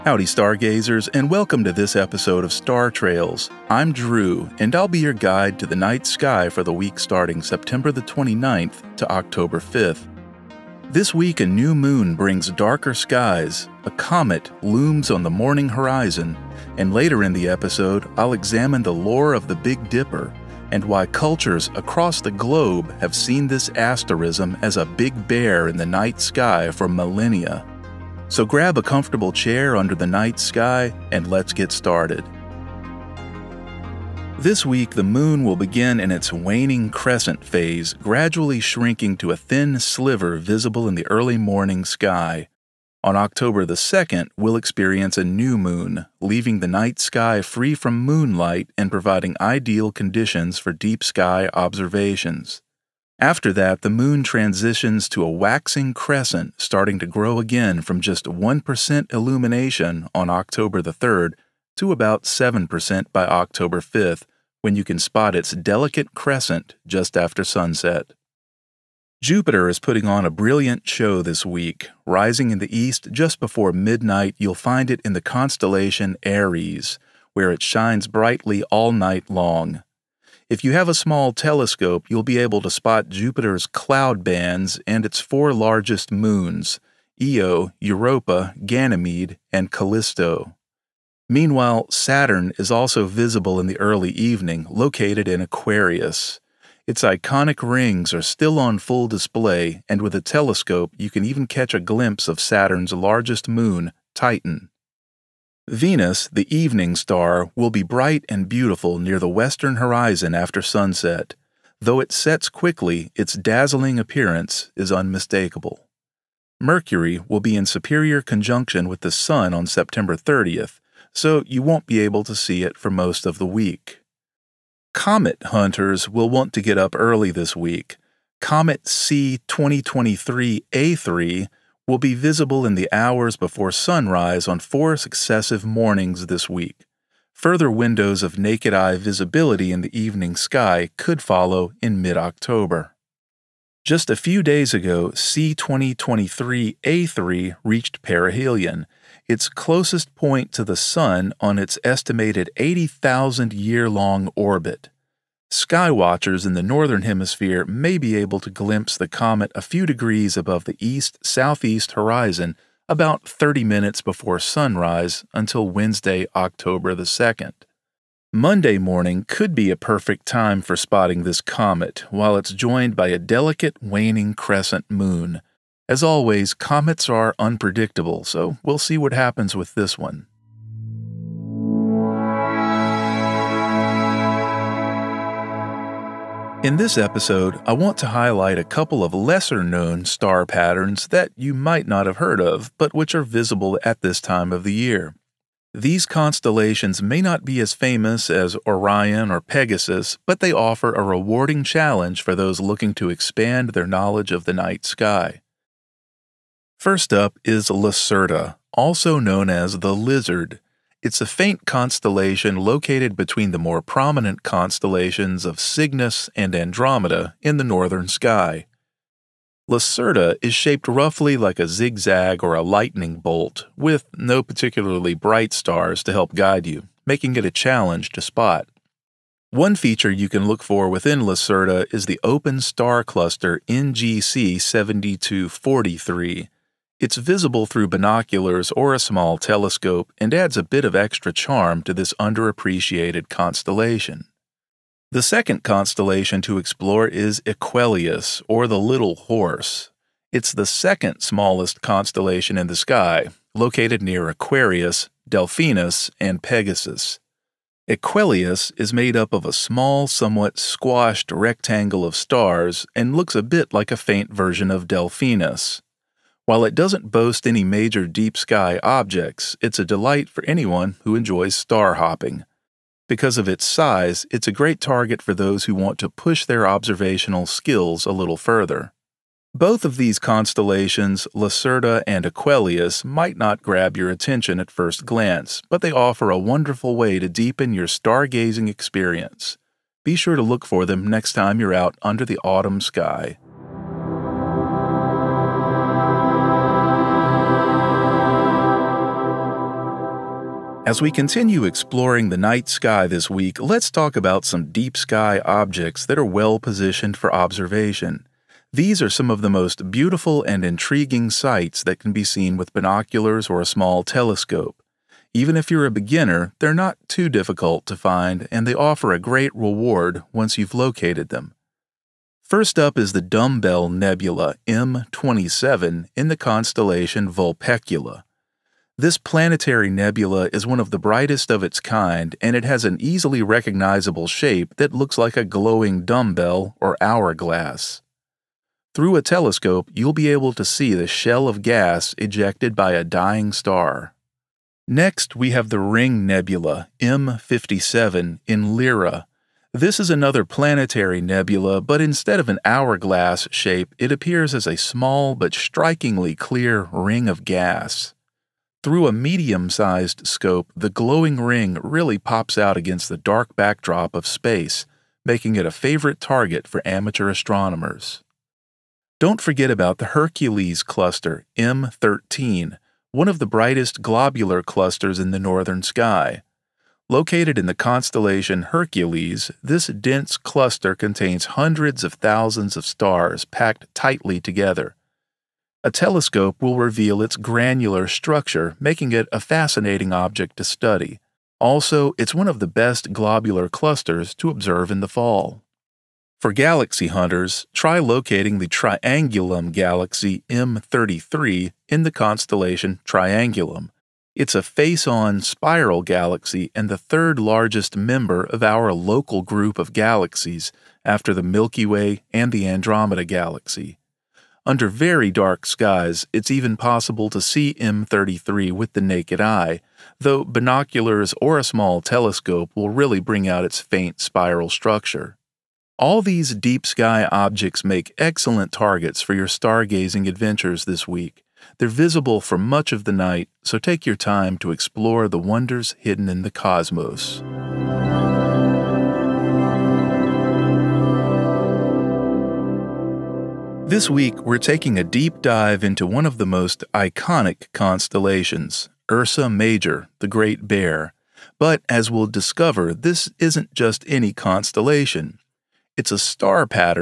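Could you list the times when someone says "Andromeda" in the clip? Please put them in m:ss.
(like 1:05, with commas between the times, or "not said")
3:36, 6:52.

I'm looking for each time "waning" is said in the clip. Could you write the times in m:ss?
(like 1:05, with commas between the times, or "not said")
0:36, 2:53.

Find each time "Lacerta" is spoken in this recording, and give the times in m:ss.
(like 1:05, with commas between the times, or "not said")
3:27, 3:39, 3:51, 4:41.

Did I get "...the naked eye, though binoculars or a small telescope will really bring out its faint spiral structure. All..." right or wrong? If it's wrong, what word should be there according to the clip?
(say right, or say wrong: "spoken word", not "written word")
right.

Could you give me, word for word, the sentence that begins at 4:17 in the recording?
Equuleus is made up of a small, somewhat squashed rectangle of stars and looks a bit like a faint version of Delphinus.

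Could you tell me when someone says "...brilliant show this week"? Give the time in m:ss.
1:10.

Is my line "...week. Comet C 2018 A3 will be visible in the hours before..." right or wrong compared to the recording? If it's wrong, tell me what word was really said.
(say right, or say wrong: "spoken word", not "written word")
wrong: "2023", not "2018".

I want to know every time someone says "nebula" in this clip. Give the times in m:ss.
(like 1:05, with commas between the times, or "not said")
5:23, 5:29, 5:46, 5:51.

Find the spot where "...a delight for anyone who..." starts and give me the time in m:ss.
4:29.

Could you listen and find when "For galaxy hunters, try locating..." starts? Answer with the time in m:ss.
6:36.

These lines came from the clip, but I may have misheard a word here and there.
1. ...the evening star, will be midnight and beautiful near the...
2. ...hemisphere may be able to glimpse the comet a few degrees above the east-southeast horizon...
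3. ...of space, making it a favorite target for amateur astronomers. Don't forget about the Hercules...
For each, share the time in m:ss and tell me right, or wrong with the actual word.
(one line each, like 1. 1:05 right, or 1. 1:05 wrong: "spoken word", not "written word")
1. 1:46 wrong: "bright", not "midnight"
2. 2:37 right
3. 6:04 right.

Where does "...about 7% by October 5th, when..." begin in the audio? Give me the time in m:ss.
1:01.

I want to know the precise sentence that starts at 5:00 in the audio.
As we continue exploring the night sky this week, let's talk about some deep sky objects that are well positioned for observation.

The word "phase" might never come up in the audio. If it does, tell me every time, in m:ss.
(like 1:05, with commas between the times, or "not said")
0:37.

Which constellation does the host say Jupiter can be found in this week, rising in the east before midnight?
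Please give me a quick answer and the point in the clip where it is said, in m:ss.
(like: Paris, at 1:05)
Aries, at 1:16.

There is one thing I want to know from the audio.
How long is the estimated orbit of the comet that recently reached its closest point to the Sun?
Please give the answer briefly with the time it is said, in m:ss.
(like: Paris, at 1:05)
80,000 years, at 2:32.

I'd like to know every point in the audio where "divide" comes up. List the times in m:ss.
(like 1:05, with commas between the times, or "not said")
not said.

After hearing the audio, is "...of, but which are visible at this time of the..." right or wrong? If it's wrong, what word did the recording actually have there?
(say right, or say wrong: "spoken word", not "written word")
right.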